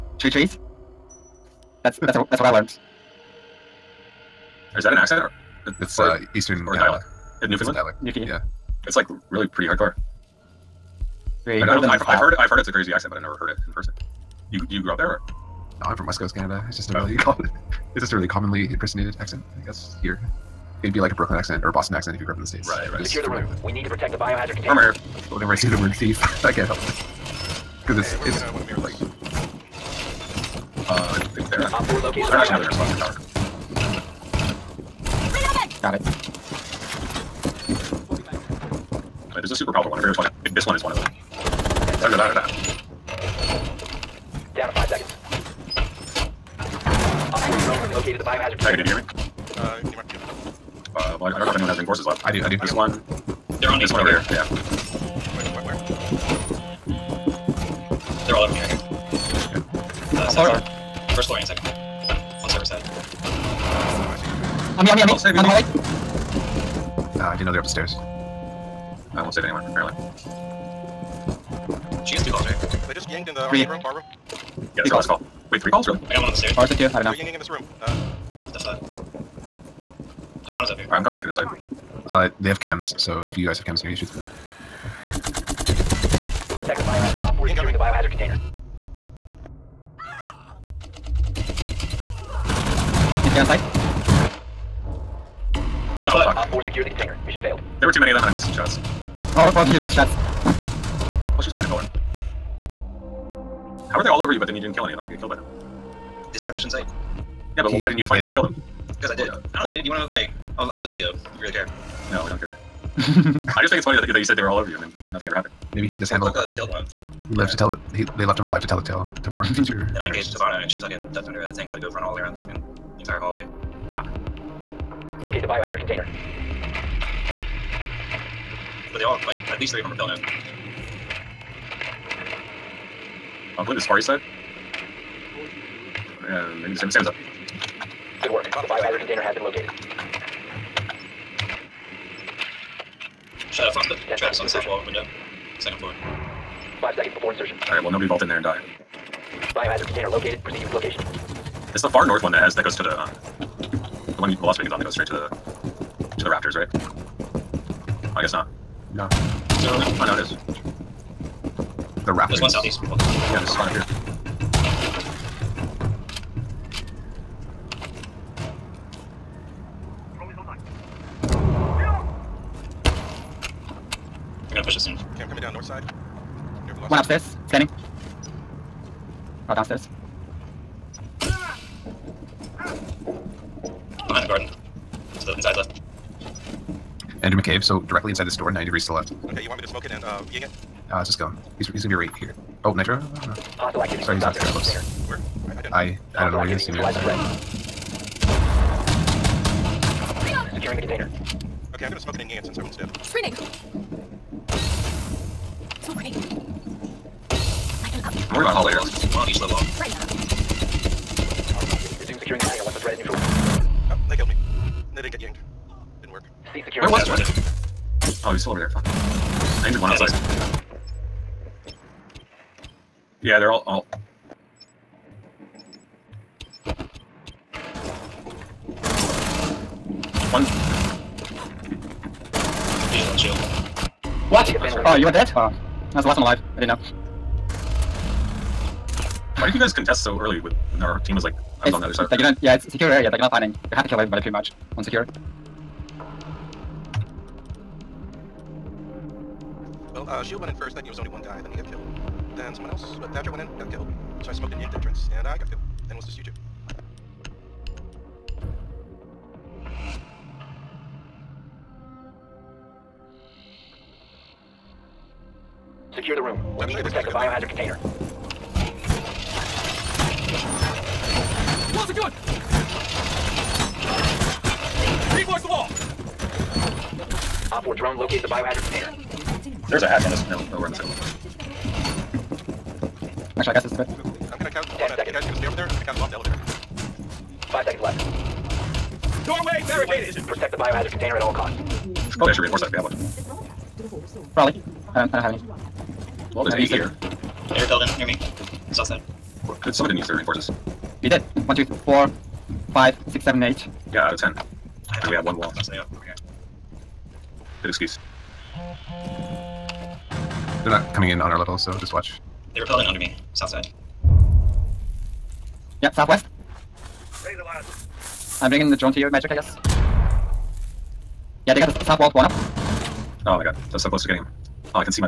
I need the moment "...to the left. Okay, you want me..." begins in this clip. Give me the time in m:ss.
3:08.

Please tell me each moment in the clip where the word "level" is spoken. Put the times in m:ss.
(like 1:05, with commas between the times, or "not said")
3:29, 5:11.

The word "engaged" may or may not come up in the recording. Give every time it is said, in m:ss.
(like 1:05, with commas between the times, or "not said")
2:00.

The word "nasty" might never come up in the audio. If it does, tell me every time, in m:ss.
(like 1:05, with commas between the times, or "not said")
not said.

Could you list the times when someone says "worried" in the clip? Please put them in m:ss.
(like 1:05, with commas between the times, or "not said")
3:28.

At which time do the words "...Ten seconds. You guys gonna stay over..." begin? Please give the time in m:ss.
4:44.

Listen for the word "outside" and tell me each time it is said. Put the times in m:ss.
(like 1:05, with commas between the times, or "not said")
1:33, 3:39.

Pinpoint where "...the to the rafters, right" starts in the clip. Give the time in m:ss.
2:35.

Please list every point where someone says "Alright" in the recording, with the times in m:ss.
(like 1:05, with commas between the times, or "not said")
1:20, 2:27.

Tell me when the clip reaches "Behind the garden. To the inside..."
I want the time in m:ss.
3:04.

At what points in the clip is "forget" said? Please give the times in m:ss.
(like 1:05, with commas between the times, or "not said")
0:40.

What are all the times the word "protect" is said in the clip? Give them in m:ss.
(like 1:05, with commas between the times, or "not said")
0:23, 1:26, 4:26, 4:50.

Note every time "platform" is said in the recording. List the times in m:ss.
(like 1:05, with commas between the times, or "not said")
not said.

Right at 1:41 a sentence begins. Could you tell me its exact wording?
Well, she was behind the pillar.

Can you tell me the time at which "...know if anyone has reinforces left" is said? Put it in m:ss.
0:51.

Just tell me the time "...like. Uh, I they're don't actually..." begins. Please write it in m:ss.
0:28.